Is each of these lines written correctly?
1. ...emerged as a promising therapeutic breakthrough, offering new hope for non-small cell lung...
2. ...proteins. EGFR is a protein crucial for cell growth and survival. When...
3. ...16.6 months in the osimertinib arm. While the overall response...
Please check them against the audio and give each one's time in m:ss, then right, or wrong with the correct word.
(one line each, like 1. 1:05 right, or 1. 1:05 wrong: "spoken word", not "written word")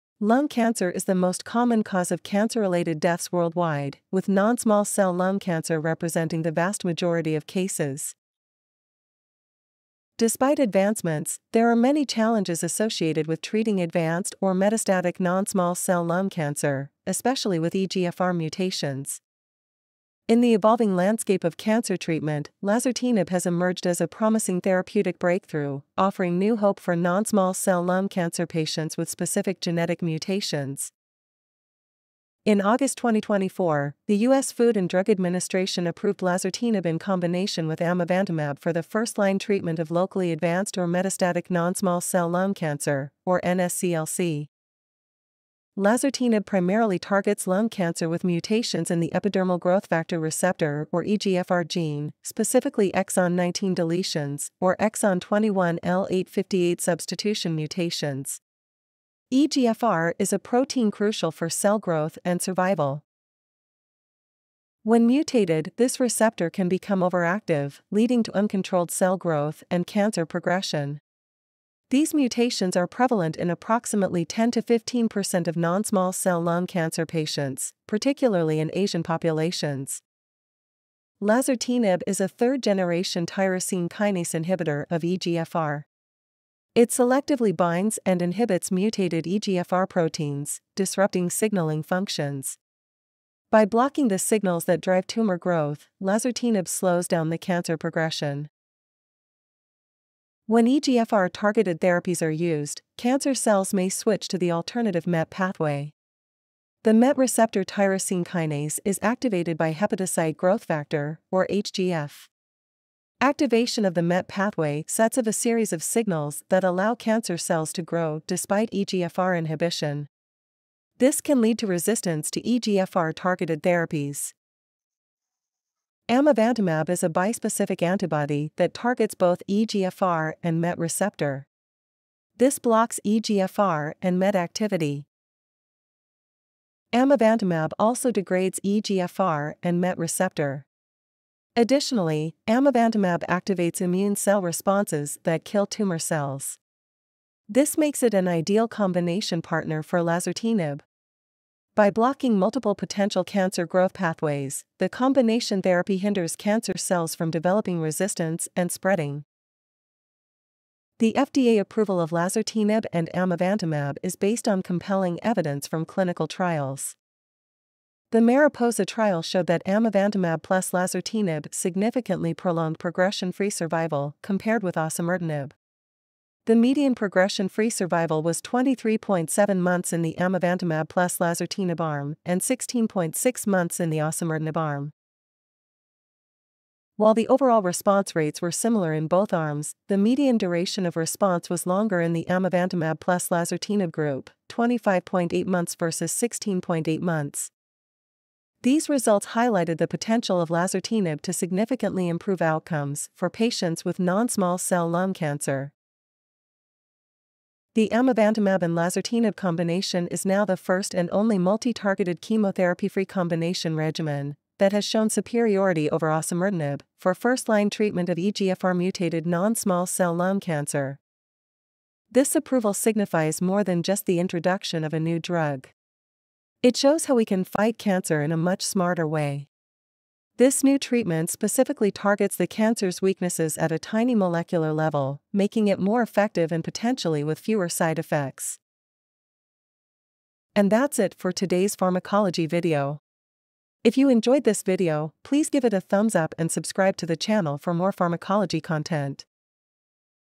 1. 0:23 right
2. 0:57 wrong: "mutations", not "proteins"
3. 3:02 right.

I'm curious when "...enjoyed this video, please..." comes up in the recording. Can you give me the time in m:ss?
4:04.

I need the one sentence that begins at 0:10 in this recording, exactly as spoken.
Despite advancements, there are many challenges associated with treating advanced or metastatic non-small cell lung cancer, especially with EGFR mutations.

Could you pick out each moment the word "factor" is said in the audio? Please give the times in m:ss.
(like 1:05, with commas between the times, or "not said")
0:49, 1:50.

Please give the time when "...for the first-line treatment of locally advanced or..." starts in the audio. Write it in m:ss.
0:38.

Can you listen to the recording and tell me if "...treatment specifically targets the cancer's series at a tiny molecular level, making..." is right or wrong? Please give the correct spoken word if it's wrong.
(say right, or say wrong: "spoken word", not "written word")
wrong: "weaknesses", not "series".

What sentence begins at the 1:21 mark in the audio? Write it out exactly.
Lazertinib is a third generation tyrosine kinase inhibitor of EGFR.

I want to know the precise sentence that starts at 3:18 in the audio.
These results highlighted the potential of lazertinib to significantly improve outcomes for patients with non-small cell lung cancer.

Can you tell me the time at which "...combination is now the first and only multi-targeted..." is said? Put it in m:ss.
3:29.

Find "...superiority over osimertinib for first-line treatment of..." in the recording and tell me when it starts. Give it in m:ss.
3:35.